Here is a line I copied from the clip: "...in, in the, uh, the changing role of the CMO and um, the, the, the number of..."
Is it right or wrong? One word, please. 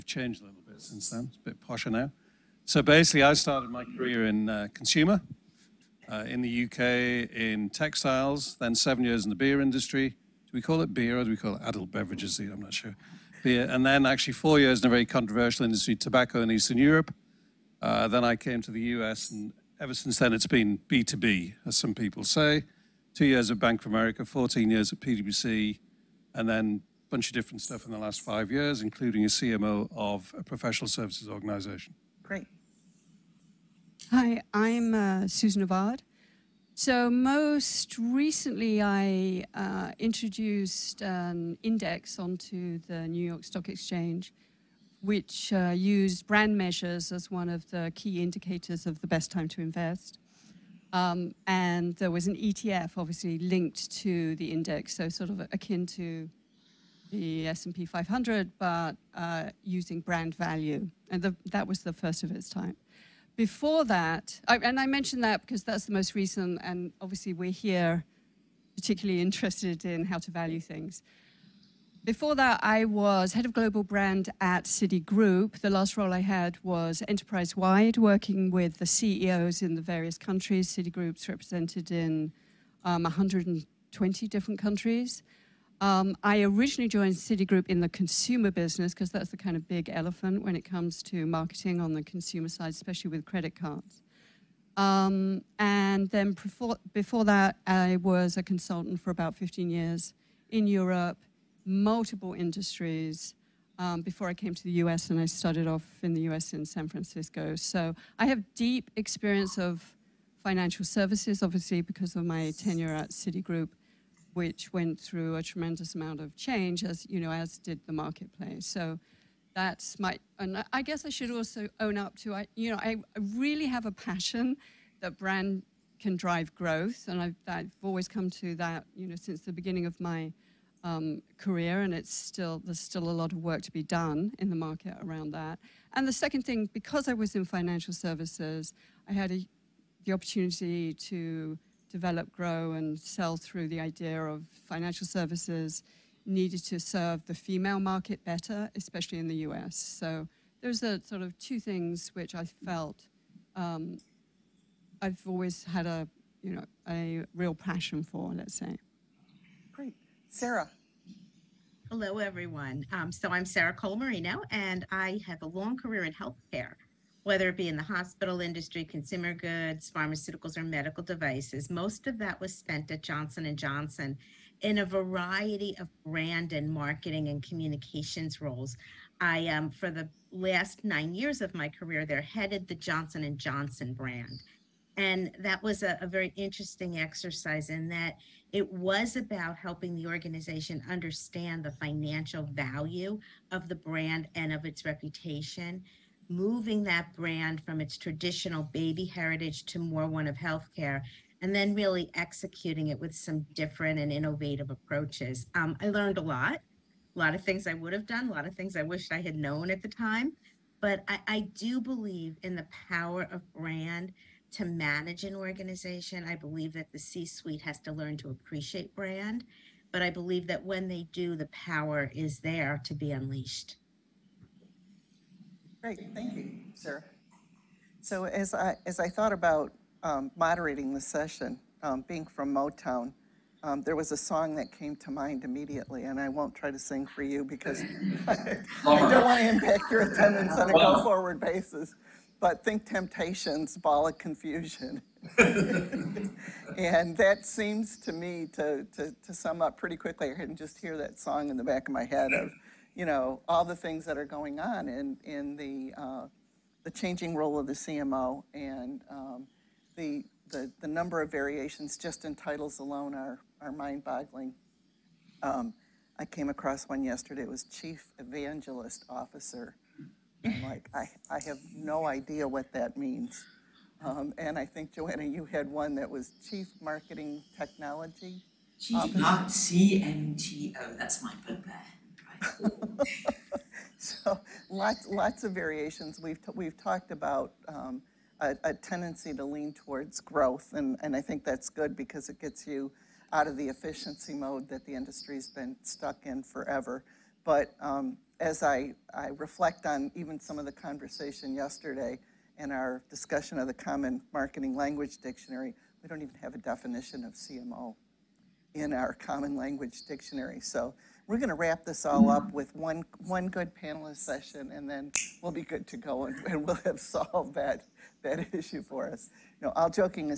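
right.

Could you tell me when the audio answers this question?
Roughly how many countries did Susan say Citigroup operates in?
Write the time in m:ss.
1:23.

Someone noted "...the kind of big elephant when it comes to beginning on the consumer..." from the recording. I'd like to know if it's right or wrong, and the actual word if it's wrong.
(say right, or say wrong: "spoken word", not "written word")
wrong: "marketing", not "beginning".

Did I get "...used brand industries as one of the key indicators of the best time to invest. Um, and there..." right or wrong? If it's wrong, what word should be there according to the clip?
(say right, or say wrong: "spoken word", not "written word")
wrong: "measures", not "industries".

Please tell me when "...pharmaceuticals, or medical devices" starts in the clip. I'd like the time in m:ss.
2:49.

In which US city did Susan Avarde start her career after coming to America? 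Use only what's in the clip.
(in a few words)
San Francisco.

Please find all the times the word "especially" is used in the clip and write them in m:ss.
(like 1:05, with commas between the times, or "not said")
1:32, 2:28.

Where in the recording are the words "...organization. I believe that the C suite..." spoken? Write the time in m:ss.
3:35.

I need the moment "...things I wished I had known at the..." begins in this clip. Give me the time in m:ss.
3:28.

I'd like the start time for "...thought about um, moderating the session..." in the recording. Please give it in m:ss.
3:49.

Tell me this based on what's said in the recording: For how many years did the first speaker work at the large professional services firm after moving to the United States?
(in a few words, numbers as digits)
14.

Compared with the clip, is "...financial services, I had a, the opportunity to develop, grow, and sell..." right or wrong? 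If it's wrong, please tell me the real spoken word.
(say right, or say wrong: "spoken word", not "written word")
right.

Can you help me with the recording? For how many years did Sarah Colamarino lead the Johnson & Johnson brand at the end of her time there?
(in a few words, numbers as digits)
9.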